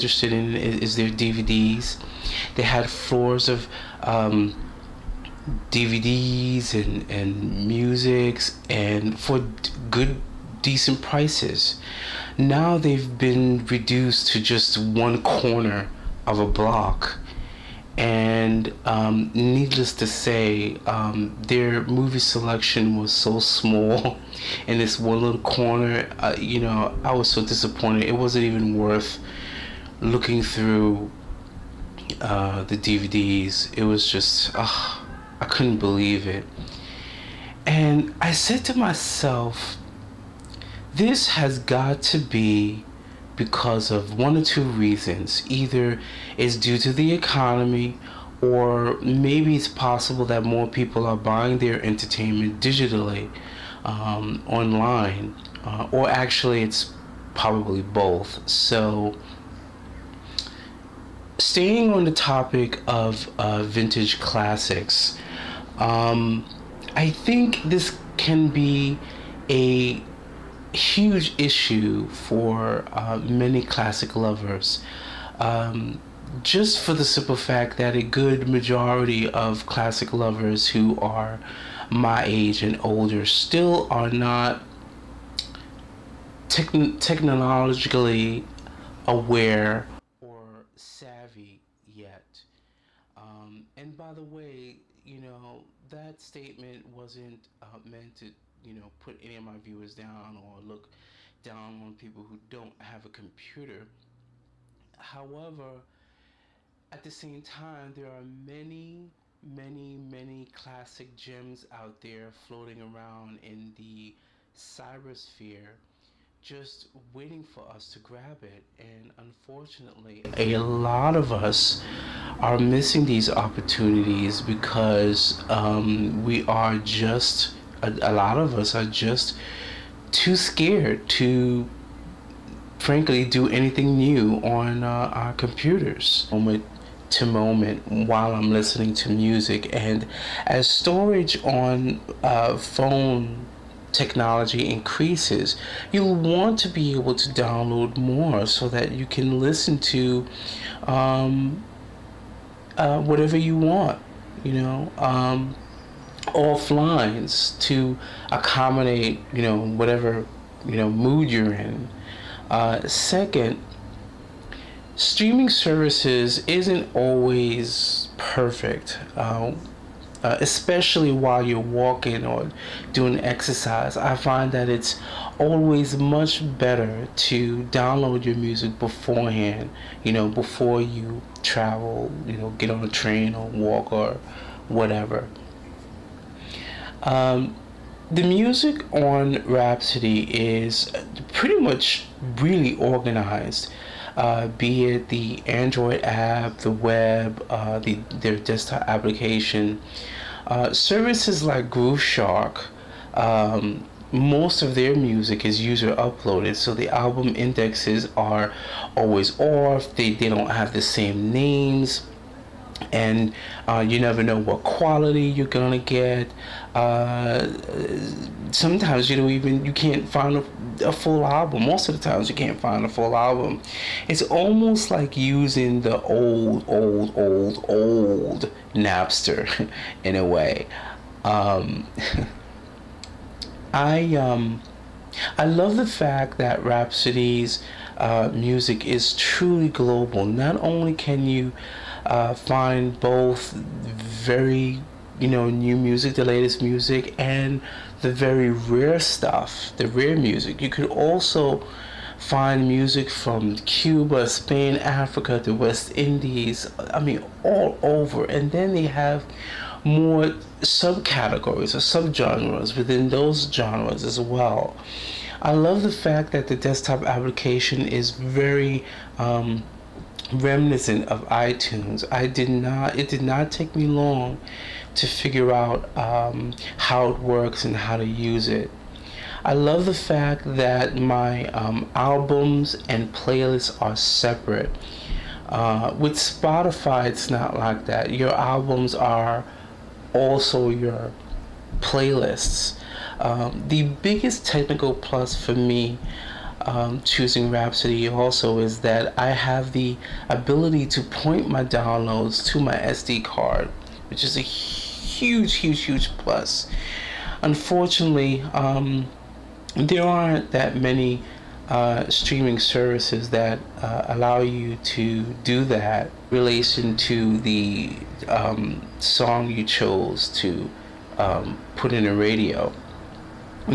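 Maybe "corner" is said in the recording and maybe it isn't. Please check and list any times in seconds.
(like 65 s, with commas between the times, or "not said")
15 s, 25 s.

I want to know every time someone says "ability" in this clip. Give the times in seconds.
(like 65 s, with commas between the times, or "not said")
300 s.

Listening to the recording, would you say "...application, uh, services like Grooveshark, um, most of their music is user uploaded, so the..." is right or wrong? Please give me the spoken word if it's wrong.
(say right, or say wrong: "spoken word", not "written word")
right.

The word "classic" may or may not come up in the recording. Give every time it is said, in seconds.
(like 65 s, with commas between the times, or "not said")
64 s, 73 s, 79 s, 110 s.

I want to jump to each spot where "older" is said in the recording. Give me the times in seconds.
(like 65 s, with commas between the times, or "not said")
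82 s.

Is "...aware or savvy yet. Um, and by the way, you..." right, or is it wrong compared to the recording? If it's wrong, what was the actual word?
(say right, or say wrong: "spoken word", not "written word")
right.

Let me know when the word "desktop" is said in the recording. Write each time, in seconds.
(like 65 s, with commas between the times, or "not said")
198 s, 266 s.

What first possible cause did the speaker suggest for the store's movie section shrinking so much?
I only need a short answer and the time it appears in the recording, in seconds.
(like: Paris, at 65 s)
the economy, at 46 s.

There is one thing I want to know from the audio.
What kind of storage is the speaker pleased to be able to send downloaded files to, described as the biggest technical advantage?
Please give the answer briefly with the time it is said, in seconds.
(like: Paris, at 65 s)
SD card, at 302 s.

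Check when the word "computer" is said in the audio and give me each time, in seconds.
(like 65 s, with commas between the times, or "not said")
103 s, 135 s.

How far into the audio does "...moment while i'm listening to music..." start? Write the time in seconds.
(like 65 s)
137 s.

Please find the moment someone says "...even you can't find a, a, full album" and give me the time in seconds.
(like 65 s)
219 s.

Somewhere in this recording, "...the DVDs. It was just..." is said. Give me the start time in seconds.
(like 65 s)
32 s.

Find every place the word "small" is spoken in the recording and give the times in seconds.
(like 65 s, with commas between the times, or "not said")
23 s.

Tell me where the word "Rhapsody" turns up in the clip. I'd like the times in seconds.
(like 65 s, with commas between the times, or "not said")
189 s, 236 s, 297 s.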